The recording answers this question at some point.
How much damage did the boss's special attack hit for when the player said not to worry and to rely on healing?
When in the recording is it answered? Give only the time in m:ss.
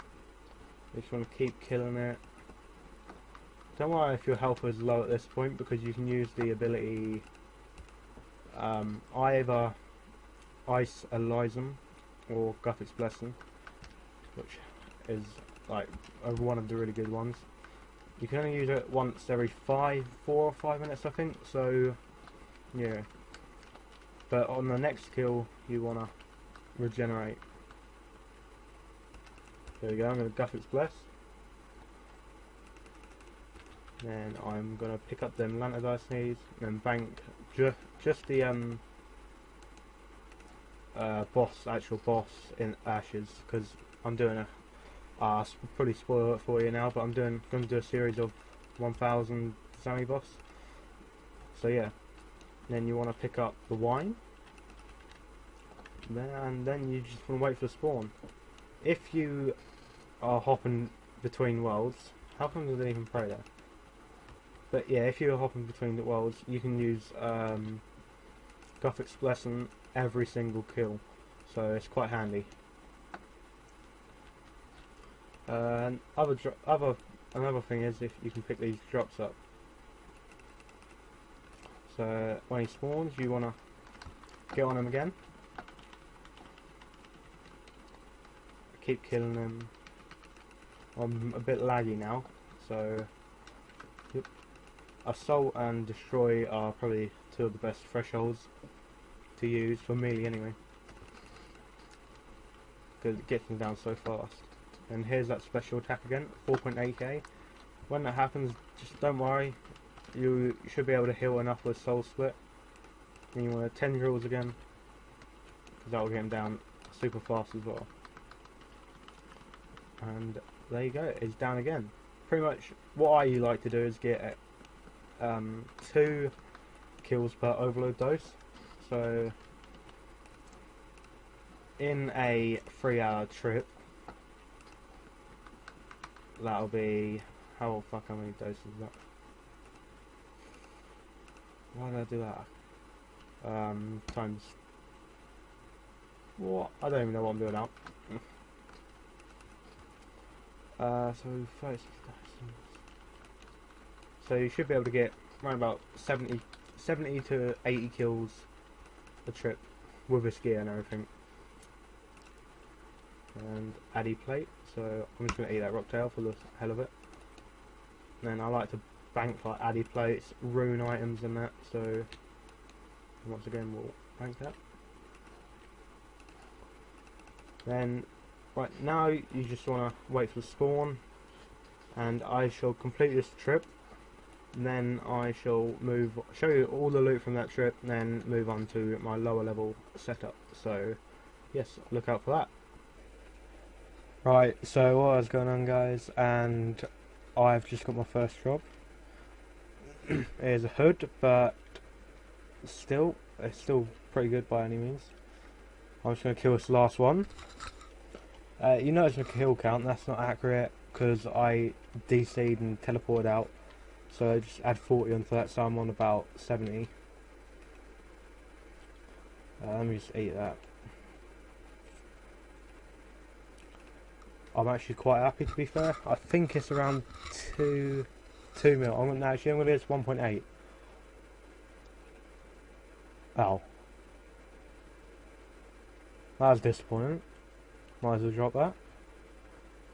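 1:46.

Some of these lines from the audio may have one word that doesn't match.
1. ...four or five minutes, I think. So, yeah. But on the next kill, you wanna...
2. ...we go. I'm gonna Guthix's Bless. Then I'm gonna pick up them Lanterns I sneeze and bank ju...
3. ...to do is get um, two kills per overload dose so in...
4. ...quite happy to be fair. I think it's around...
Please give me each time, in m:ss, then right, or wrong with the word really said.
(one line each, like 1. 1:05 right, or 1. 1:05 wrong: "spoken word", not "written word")
1. 0:20 right
2. 0:29 right
3. 2:03 right
4. 3:44 right.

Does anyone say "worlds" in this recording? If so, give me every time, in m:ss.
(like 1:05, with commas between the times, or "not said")
1:01, 1:06.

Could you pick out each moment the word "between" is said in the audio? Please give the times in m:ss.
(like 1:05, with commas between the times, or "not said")
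1:01, 1:05.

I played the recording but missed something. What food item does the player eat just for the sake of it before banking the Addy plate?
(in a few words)
Rocktail.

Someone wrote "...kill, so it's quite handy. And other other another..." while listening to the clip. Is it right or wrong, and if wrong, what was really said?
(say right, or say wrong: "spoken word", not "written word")
right.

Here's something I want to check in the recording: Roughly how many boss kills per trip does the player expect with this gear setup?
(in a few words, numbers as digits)
70 to 80.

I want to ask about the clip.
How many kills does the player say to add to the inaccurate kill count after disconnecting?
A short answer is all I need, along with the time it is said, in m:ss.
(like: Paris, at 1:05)
40, at 3:34.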